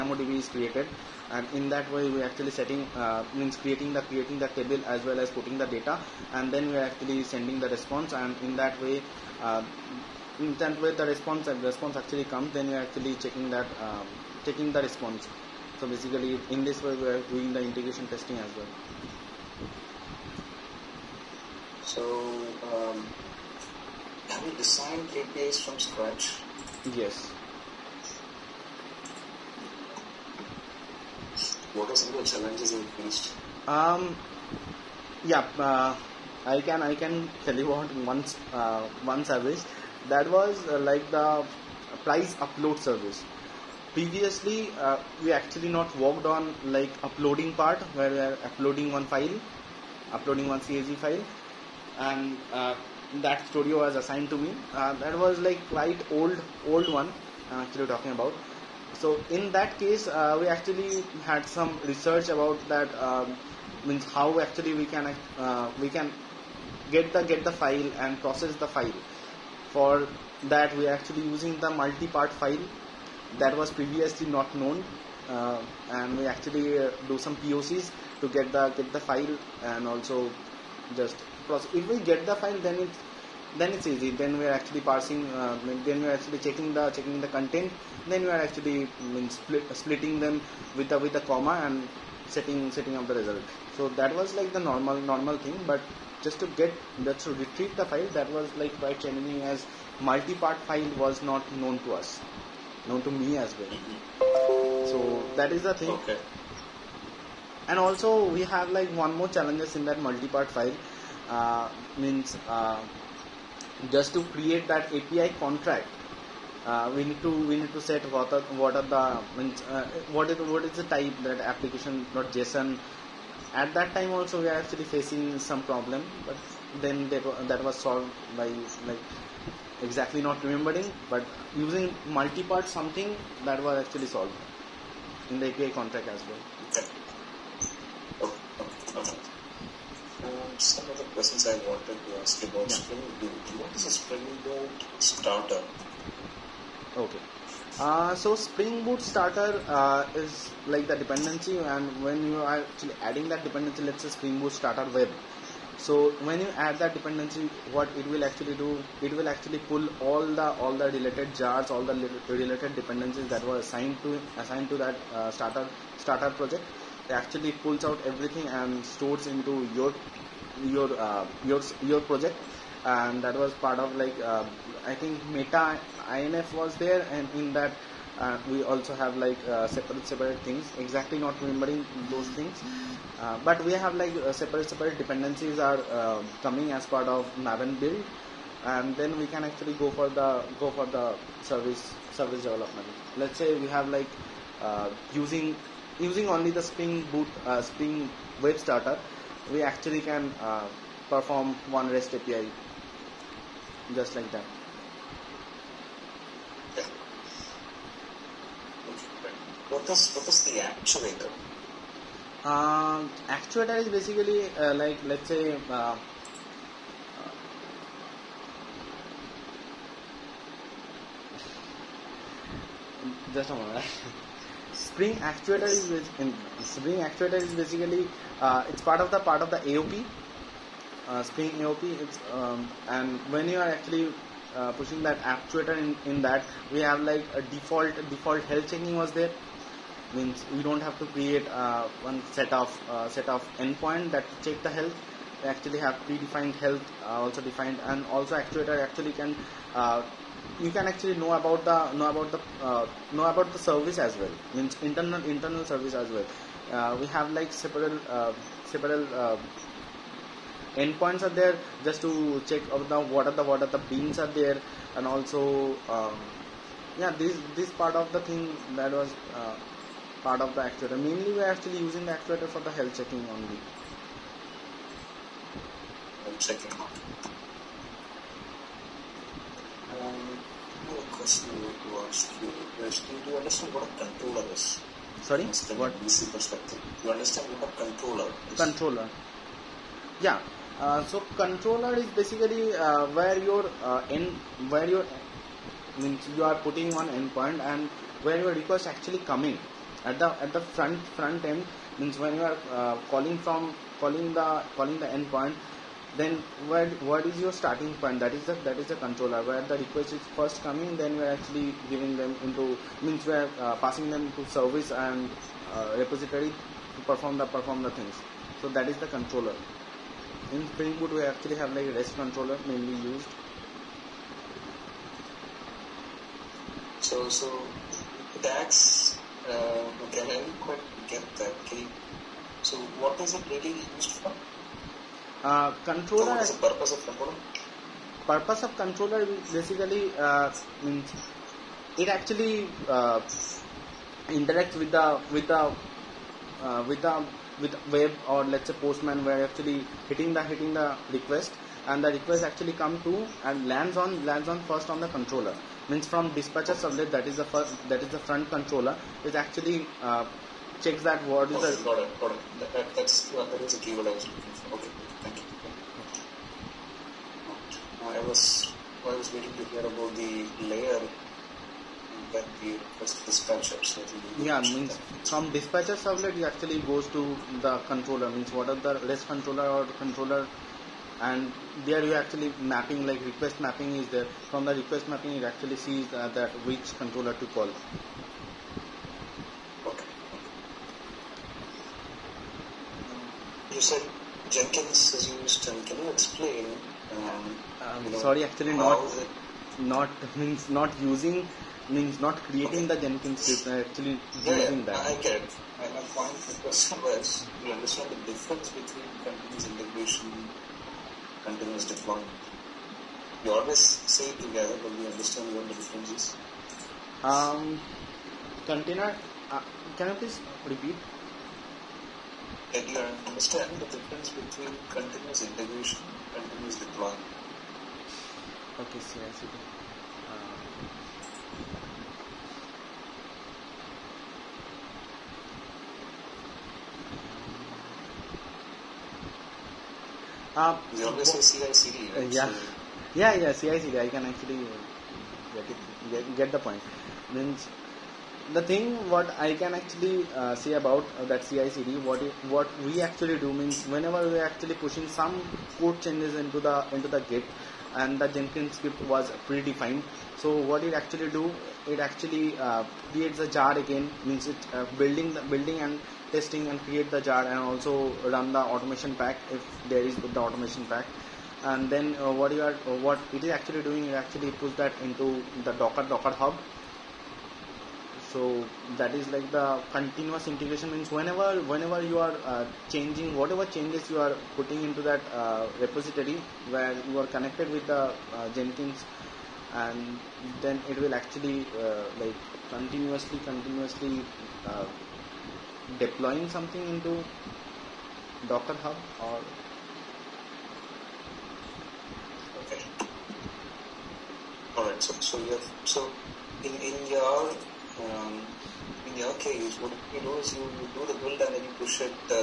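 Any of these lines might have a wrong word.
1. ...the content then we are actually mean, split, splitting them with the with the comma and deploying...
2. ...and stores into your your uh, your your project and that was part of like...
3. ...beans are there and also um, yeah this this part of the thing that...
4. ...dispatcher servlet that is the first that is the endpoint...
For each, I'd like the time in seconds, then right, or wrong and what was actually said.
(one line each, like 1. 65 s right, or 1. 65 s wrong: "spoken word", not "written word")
1. 87 s wrong: "setting", not "deploying"
2. 168 s right
3. 263 s right
4. 356 s wrong: "front", not "endpoint".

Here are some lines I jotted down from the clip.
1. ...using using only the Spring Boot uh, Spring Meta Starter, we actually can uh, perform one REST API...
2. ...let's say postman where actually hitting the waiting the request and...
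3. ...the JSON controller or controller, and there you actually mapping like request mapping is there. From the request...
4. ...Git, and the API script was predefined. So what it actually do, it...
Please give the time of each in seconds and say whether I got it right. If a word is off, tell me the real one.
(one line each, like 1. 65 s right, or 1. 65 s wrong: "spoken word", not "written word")
1. 195 s wrong: "Web", not "Meta"
2. 348 s wrong: "hitting", not "waiting"
3. 378 s wrong: "REST", not "JSON"
4. 457 s wrong: "Jenkins", not "API".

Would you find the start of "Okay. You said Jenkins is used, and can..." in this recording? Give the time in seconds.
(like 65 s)
389 s.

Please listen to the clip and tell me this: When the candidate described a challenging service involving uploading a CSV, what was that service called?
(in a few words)
price upload service.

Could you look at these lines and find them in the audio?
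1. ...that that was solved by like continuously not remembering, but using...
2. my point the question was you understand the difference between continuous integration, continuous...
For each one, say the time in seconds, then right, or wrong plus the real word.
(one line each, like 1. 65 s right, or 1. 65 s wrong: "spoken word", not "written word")
1. 127 s wrong: "exactly", not "continuously"
2. 405 s right.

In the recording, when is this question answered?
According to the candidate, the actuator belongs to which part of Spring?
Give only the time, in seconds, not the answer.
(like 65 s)
231 s.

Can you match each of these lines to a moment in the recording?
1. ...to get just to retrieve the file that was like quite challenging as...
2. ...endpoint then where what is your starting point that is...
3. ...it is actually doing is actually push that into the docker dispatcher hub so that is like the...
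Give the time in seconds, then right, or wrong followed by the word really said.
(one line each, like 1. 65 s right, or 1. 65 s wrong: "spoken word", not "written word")
1. 96 s right
2. 305 s right
3. 473 s wrong: "docker", not "dispatcher".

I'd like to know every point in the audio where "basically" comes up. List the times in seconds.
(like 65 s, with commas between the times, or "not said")
15 s, 213 s, 227 s, 292 s, 339 s.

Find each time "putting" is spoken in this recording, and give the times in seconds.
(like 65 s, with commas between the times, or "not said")
5 s, 296 s, 484 s.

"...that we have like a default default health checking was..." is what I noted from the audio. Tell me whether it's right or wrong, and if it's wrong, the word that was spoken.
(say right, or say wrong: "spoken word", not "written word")
right.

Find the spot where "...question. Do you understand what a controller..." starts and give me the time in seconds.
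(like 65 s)
282 s.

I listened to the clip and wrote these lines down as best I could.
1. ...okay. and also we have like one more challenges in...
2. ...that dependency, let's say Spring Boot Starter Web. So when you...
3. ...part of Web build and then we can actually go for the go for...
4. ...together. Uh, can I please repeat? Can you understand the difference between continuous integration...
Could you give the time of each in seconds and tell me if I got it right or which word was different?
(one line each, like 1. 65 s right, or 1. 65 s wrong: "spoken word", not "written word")
1. 105 s right
2. 153 s right
3. 186 s wrong: "Maven", not "Web"
4. 418 s wrong: "container", not "together".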